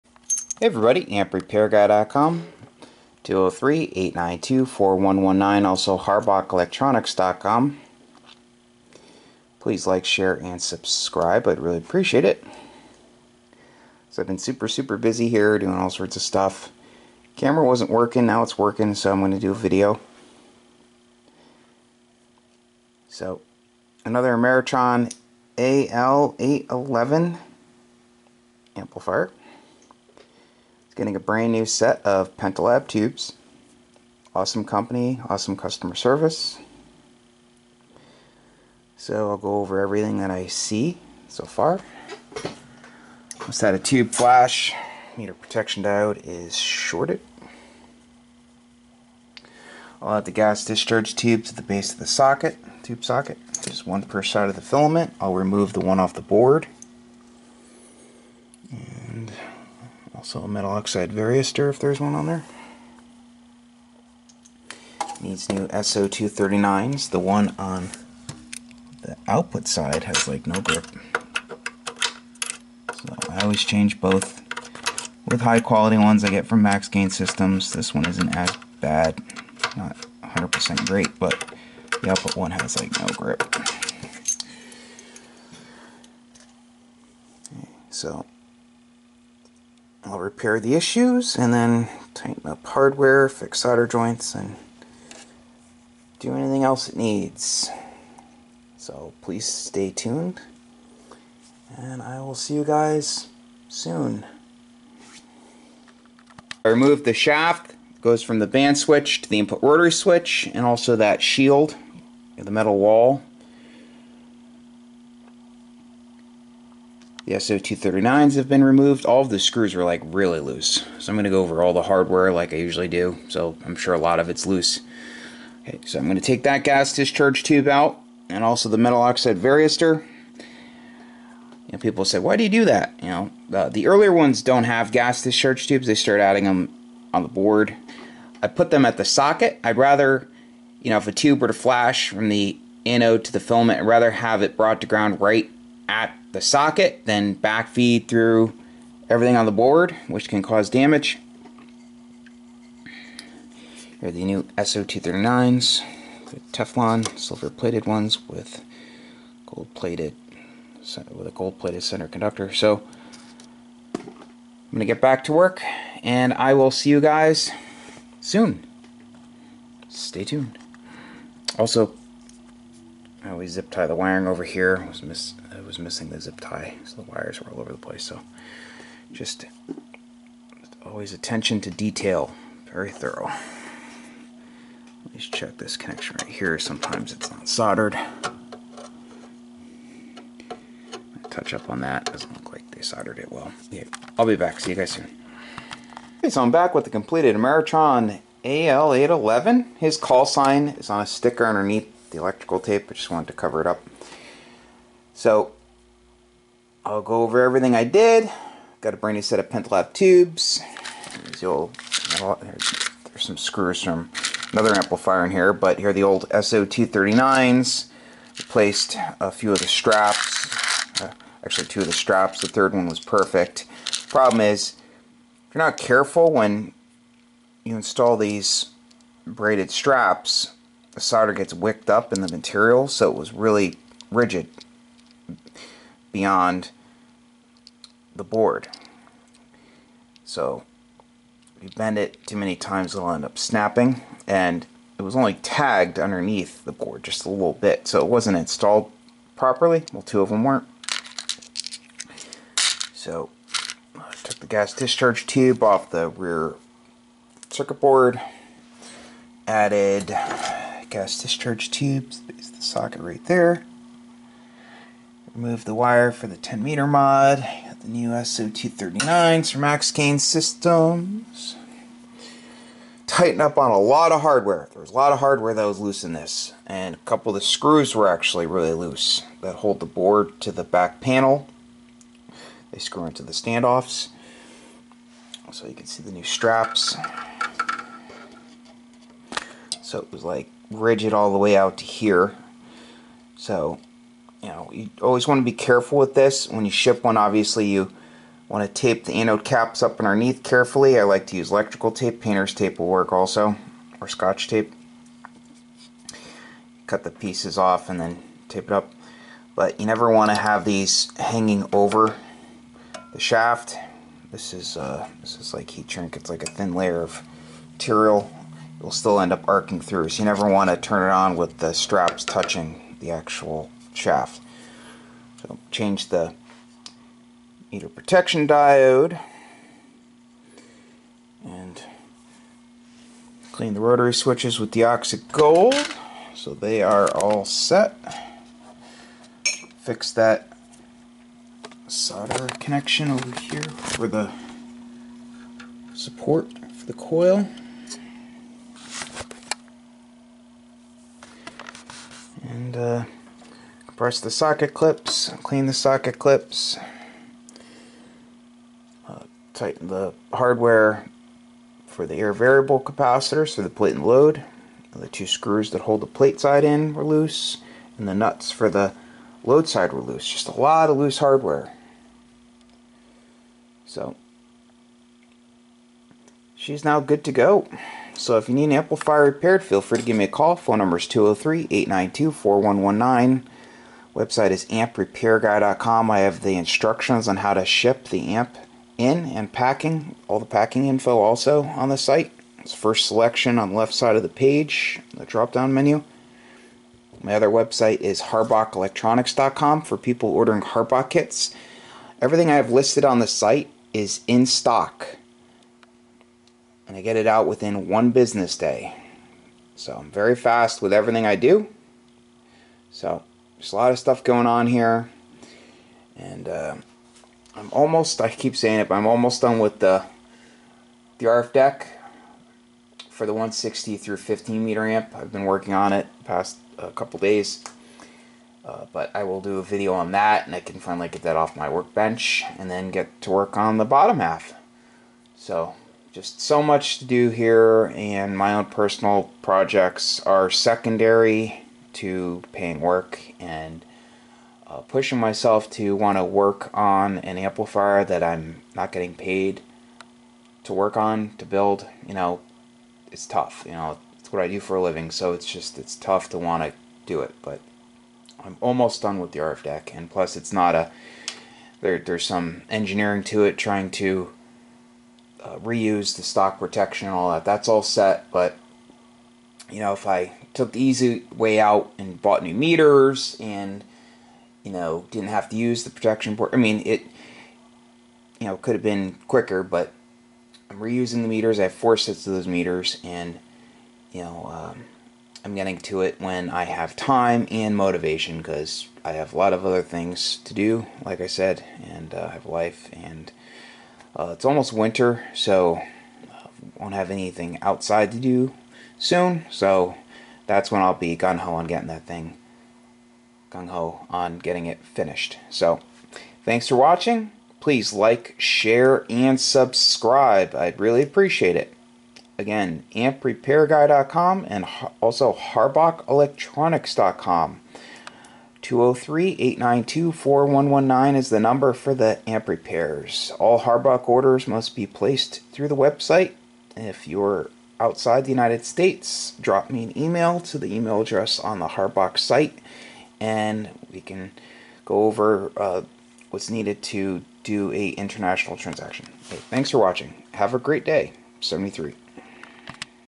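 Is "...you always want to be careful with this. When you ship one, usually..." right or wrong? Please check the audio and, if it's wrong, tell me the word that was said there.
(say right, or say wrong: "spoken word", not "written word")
wrong: "obviously", not "usually".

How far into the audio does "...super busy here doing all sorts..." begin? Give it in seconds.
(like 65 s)
14 s.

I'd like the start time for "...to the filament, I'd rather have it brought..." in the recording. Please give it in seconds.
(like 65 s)
143 s.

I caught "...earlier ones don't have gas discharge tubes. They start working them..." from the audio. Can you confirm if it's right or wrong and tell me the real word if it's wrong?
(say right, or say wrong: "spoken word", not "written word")
wrong: "adding", not "working".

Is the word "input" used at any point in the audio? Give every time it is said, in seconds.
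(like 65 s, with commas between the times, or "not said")
109 s.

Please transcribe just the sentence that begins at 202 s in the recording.
I just wanted to cover it up.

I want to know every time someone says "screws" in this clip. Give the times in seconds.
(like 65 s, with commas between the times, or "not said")
119 s, 213 s, 277 s, 282 s, 365 s.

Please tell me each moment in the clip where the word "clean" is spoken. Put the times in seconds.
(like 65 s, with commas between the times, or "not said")
333 s, 355 s.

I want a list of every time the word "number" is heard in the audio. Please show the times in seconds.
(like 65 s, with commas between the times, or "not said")
380 s, 521 s.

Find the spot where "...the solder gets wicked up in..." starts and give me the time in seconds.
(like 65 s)
230 s.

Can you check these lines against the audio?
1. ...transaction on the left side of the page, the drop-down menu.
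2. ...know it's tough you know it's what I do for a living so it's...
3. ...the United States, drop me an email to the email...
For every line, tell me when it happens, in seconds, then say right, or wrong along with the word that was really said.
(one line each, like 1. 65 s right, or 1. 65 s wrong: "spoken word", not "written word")
1. 393 s wrong: "selection", not "transaction"
2. 452 s right
3. 528 s right.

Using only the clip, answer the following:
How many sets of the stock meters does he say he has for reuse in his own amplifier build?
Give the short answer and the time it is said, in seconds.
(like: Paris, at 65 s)
4, at 481 s.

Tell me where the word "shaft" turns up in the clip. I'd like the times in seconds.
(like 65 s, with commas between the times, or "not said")
107 s, 313 s, 323 s.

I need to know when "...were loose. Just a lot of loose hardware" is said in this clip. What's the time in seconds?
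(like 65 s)
369 s.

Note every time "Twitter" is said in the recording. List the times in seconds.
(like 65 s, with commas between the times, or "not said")
not said.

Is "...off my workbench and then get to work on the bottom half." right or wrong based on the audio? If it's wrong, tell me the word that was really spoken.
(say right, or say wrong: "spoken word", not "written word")
right.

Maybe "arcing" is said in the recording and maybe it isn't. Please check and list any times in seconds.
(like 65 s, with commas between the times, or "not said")
319 s.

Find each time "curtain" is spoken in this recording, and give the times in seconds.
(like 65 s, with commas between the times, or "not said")
not said.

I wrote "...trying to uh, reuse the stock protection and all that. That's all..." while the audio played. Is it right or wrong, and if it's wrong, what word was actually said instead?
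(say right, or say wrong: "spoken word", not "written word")
right.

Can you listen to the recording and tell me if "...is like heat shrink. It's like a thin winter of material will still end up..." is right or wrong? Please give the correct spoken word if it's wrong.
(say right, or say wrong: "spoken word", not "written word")
wrong: "layer", not "winter".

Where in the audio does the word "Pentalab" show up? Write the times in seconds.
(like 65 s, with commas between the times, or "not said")
32 s, 209 s.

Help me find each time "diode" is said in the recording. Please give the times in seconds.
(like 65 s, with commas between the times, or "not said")
45 s, 328 s.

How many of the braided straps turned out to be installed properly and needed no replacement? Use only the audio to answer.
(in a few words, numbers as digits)
1.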